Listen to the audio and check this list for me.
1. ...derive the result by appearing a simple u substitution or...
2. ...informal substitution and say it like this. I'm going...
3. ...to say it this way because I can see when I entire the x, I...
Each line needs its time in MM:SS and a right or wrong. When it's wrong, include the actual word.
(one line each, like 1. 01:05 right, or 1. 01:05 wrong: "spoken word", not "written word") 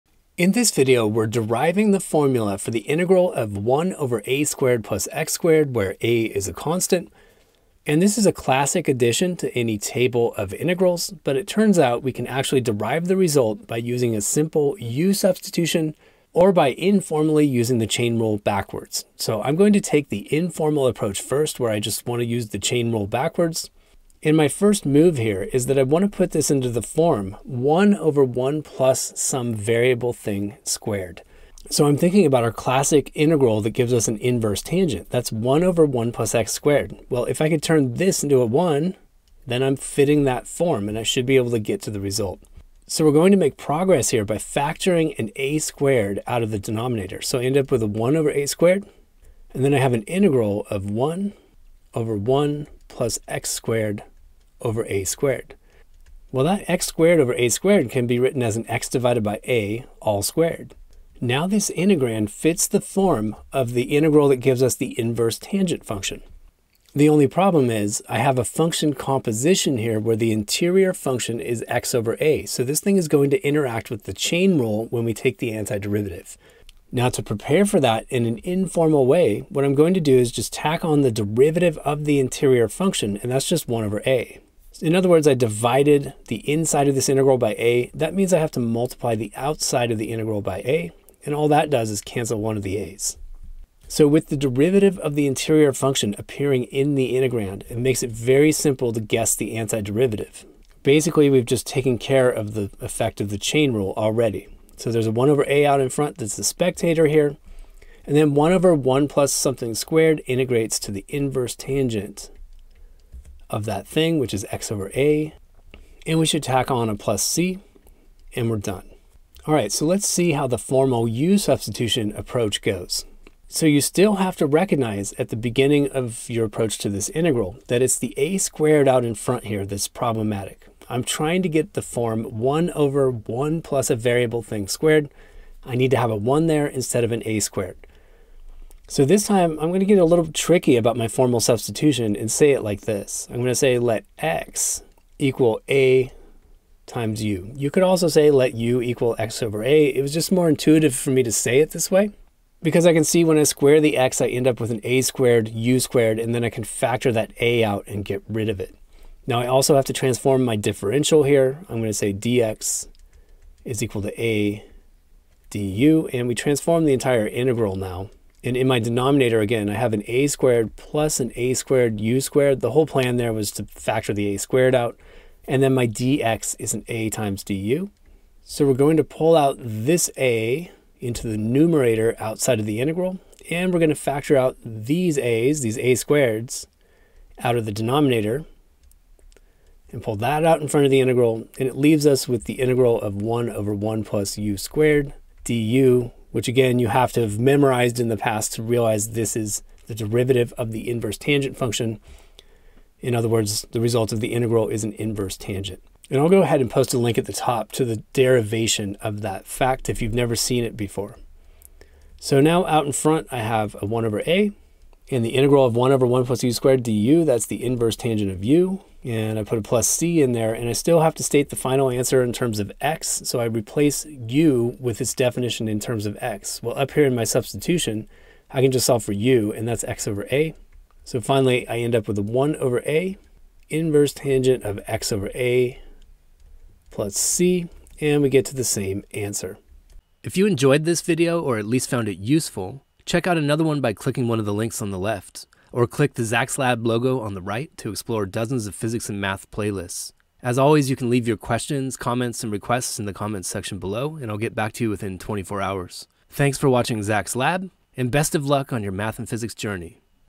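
1. 00:12 wrong: "using", not "appearing"
2. 02:21 wrong: "formal", not "informal"
3. 02:31 wrong: "square", not "entire".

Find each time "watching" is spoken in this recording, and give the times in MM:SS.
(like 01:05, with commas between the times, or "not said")
04:16.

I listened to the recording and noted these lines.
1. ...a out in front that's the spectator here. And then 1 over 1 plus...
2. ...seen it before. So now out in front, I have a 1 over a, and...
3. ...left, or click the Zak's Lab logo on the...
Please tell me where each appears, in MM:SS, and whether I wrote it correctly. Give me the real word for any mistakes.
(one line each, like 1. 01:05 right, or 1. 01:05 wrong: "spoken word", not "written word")
1. 01:45 right
2. 03:30 right
3. 04:04 right.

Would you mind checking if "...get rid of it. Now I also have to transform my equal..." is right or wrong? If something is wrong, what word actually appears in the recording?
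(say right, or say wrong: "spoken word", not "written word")
wrong: "differential", not "equal".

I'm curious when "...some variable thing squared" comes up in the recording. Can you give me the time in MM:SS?
00:29.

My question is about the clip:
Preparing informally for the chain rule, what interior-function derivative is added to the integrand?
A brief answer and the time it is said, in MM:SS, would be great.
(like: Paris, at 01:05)
1 over a, at 01:23.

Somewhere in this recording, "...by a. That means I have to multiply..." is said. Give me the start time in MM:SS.
01:27.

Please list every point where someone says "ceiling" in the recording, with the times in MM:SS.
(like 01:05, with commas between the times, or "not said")
not said.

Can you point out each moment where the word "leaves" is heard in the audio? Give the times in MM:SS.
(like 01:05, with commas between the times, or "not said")
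03:11, 04:11.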